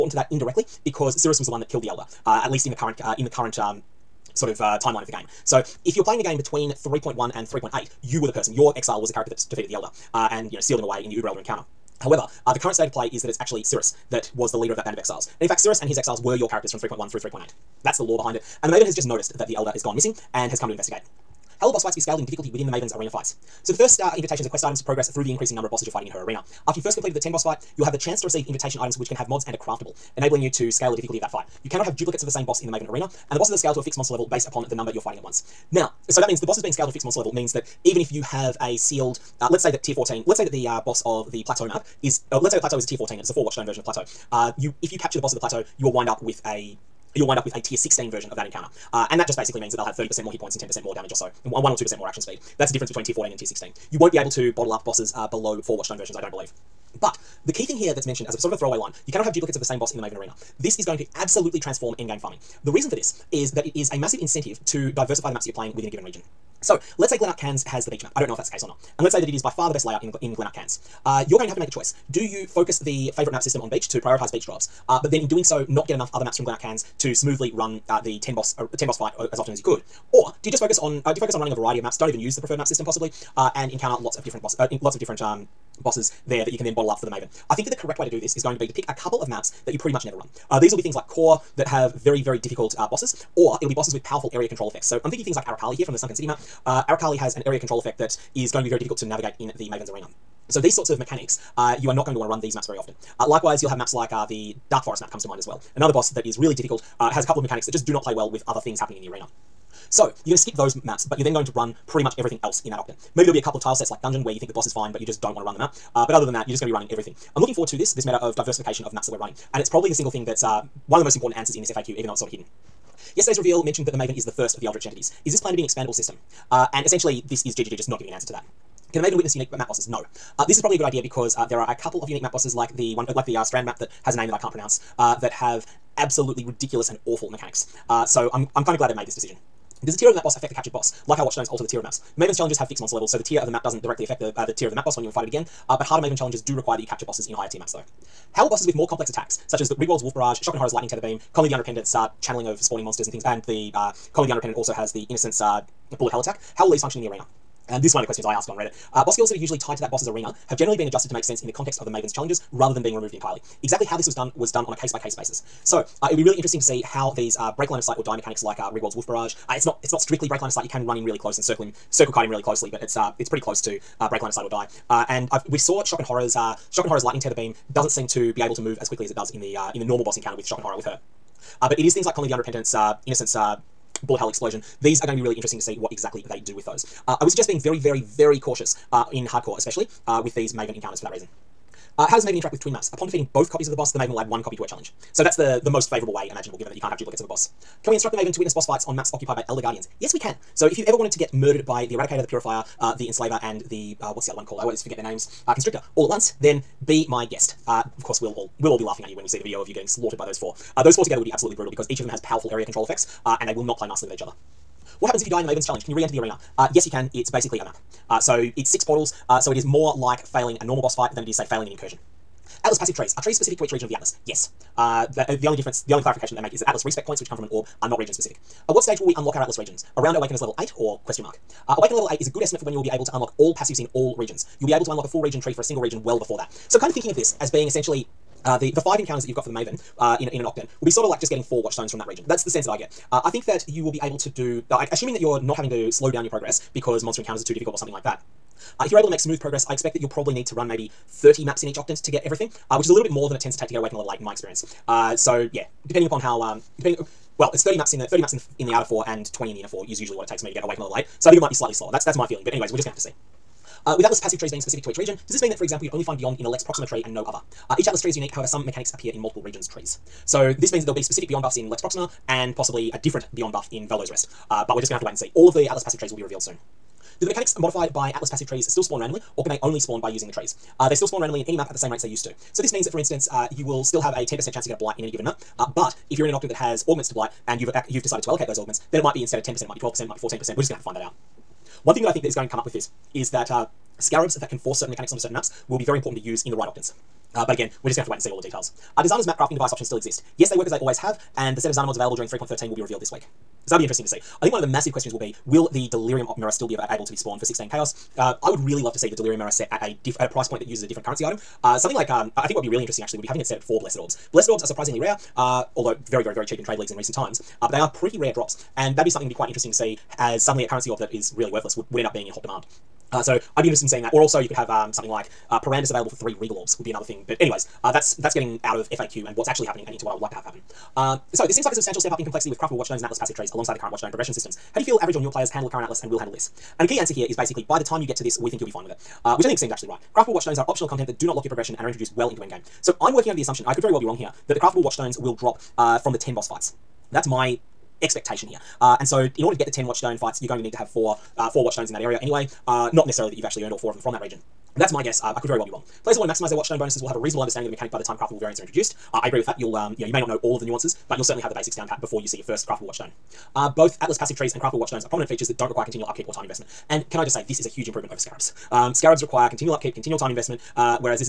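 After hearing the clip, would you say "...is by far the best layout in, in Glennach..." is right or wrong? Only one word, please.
right.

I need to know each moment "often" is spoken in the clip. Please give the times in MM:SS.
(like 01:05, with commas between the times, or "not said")
01:19, 01:42.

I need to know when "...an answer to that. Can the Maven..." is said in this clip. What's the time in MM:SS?
02:08.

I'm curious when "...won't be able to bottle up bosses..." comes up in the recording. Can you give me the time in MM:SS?
00:53.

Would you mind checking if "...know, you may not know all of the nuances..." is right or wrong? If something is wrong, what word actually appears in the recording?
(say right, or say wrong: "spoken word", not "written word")
right.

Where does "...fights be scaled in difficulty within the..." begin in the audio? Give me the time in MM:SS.
00:21.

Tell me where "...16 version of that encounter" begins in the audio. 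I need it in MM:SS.
00:47.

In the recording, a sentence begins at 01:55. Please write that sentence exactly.
Uh, but other than that, you're just going to be running everything.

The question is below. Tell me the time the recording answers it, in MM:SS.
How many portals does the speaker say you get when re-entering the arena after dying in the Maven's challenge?
03:38.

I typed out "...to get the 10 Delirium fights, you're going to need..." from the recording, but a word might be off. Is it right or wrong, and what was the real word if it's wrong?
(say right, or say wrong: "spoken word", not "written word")
wrong: "Watchstone", not "Delirium".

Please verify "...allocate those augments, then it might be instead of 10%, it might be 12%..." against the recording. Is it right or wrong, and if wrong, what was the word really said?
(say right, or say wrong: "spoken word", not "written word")
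right.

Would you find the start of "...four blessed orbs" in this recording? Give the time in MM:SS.
05:13.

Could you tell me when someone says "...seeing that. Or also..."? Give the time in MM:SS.
05:23.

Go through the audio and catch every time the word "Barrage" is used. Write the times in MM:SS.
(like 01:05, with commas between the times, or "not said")
02:30, 02:49.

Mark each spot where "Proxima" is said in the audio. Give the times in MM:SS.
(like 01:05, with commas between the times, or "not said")
04:26, 04:31.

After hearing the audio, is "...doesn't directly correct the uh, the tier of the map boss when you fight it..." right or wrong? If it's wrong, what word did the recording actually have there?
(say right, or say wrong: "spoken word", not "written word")
wrong: "affect", not "correct".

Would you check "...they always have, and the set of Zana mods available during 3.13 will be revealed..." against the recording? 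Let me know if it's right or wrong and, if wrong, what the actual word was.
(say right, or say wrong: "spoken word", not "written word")
right.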